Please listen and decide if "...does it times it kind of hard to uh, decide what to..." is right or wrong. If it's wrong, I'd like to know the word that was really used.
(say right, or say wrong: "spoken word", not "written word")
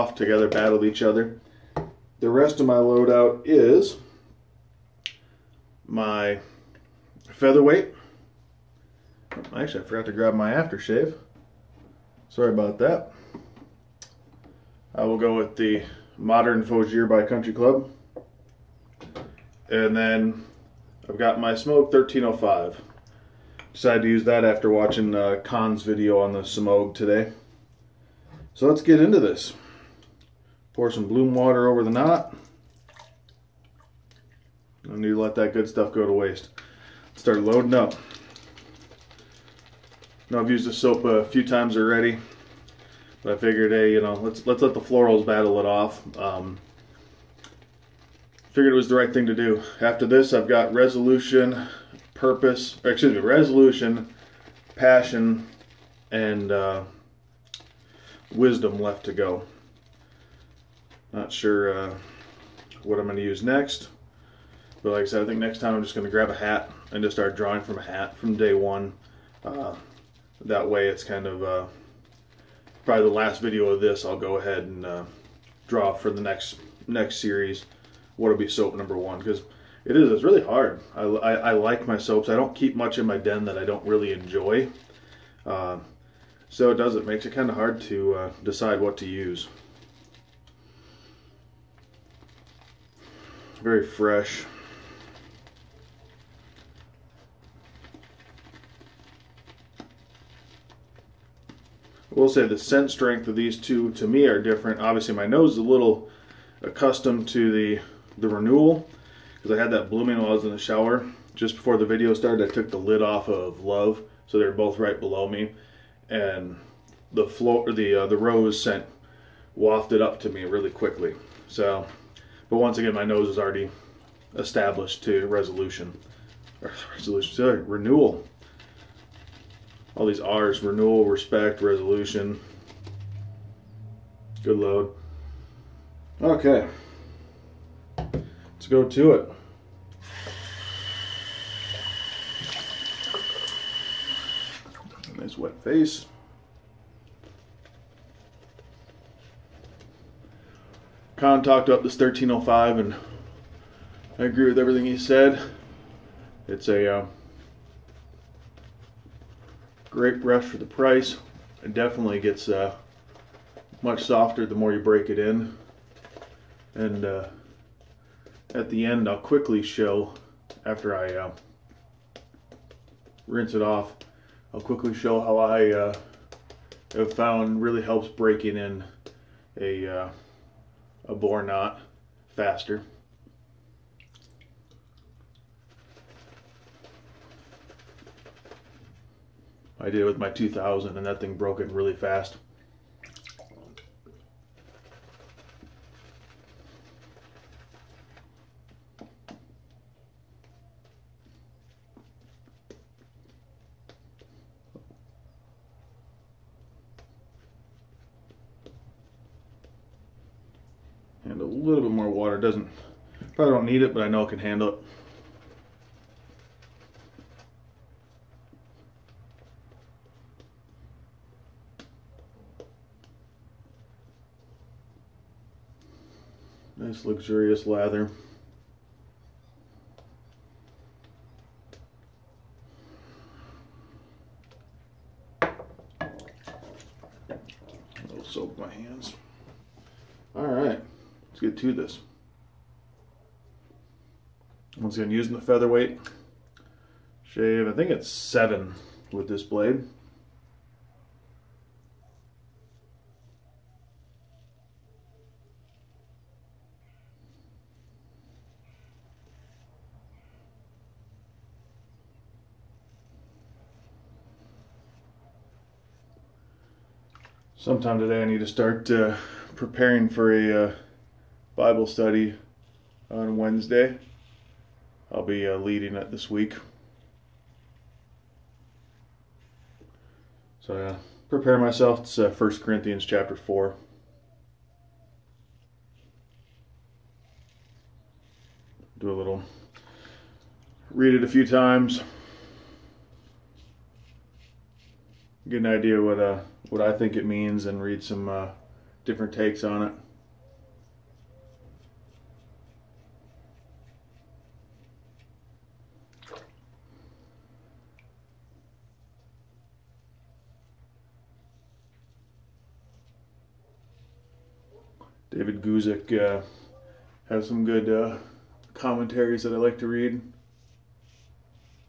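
wrong: "makes", not "times".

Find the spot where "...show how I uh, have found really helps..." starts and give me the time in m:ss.
2:54.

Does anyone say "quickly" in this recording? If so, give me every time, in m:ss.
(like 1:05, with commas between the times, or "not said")
2:00, 2:49, 2:54.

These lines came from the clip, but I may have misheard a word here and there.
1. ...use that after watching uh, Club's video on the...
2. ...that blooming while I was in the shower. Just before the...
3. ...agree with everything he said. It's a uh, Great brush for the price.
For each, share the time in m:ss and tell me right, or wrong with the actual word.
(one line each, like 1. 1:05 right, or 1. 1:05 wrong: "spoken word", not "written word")
1. 0:24 wrong: "Khan", not "Club"
2. 1:49 right
3. 2:34 right.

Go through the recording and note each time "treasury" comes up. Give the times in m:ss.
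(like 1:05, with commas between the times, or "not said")
not said.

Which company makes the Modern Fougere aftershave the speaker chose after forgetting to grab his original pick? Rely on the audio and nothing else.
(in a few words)
Country Club.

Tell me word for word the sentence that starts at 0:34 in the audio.
Don't need to let that good stuff go to waste.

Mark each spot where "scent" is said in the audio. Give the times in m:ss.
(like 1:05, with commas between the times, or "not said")
1:42, 1:58.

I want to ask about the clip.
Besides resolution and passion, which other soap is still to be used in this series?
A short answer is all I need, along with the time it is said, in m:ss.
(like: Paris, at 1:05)
Wisdom, at 0:58.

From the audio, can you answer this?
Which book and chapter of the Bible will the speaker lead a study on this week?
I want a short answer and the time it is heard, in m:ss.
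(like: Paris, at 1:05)
1 Corinthians 4, at 4:42.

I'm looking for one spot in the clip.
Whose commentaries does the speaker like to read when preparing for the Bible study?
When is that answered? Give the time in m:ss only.
5:15.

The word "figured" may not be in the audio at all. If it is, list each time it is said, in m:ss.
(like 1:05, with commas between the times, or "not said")
0:43, 0:48.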